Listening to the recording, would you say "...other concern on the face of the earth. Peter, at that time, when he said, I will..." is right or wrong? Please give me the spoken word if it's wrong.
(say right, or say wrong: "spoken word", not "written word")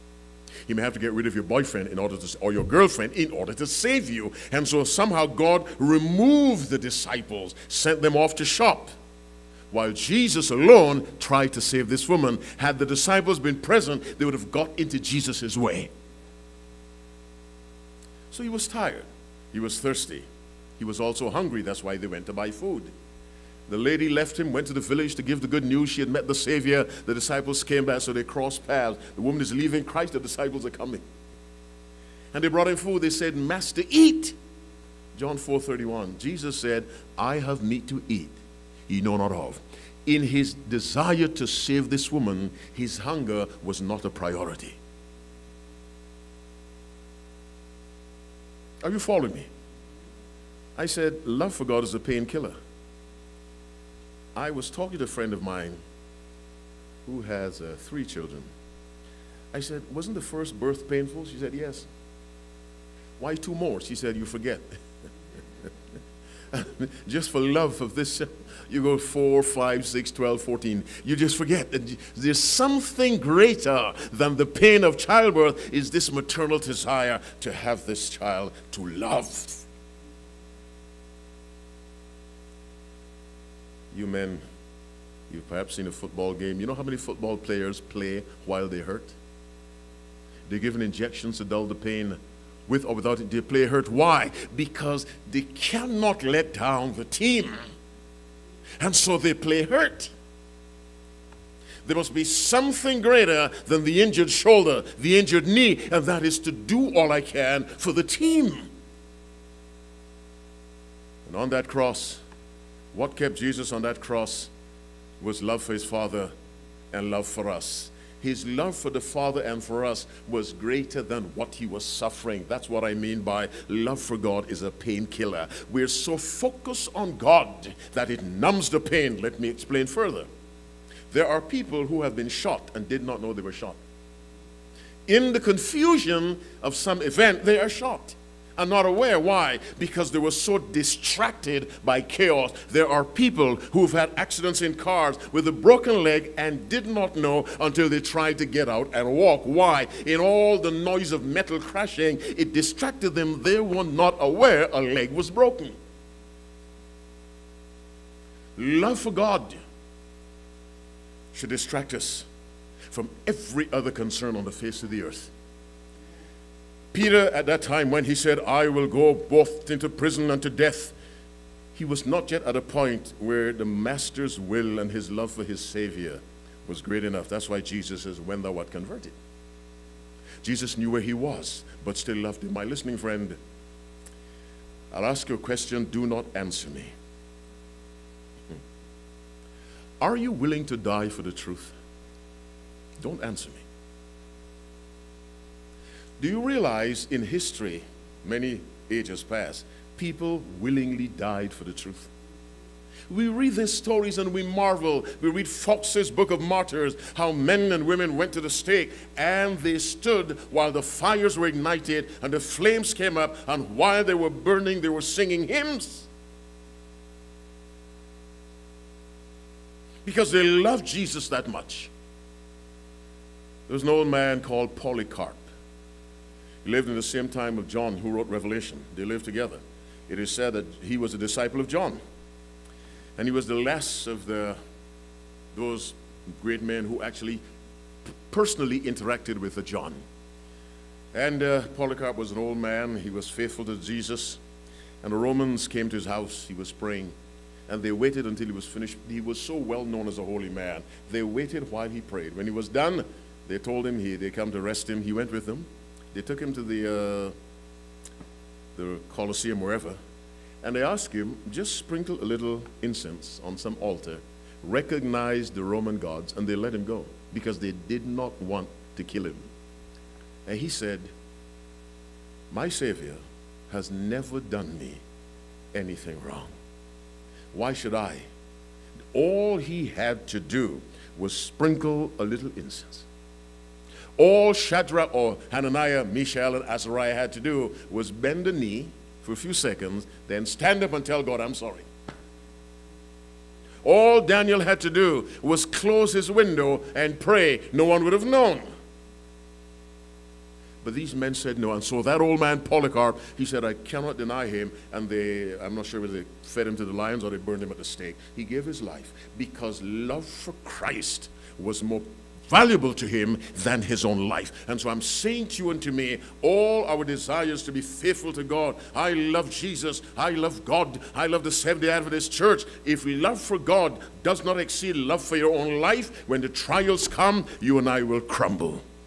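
right.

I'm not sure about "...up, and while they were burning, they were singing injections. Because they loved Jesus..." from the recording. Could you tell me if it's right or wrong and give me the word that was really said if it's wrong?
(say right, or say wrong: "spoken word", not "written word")
wrong: "hymns", not "injections".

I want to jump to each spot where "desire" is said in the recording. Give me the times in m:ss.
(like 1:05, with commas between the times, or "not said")
0:40, 1:16, 5:17.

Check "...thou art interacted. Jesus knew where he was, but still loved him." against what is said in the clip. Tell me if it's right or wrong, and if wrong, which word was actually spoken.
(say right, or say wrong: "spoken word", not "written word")
wrong: "converted", not "interacted".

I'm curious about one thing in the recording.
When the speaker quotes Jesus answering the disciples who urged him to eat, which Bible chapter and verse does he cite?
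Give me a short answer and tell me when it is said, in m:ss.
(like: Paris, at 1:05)
John 4:31, at 0:35.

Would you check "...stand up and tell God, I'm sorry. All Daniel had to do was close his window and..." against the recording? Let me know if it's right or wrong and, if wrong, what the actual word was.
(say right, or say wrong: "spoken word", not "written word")
right.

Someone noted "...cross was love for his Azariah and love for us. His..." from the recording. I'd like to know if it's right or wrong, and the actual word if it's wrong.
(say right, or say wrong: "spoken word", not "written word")
wrong: "Father", not "Azariah".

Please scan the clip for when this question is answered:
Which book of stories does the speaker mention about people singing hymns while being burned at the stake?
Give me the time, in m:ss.
3:25.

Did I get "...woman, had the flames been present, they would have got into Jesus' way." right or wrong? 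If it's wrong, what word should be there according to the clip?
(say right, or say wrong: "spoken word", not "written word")
wrong: "disciples", not "flames".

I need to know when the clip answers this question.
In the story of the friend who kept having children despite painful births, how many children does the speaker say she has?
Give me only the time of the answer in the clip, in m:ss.
0:57.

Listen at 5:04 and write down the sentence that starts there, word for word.
And they, I'm not sure whether they fed him to the lions or they burned him at the stake.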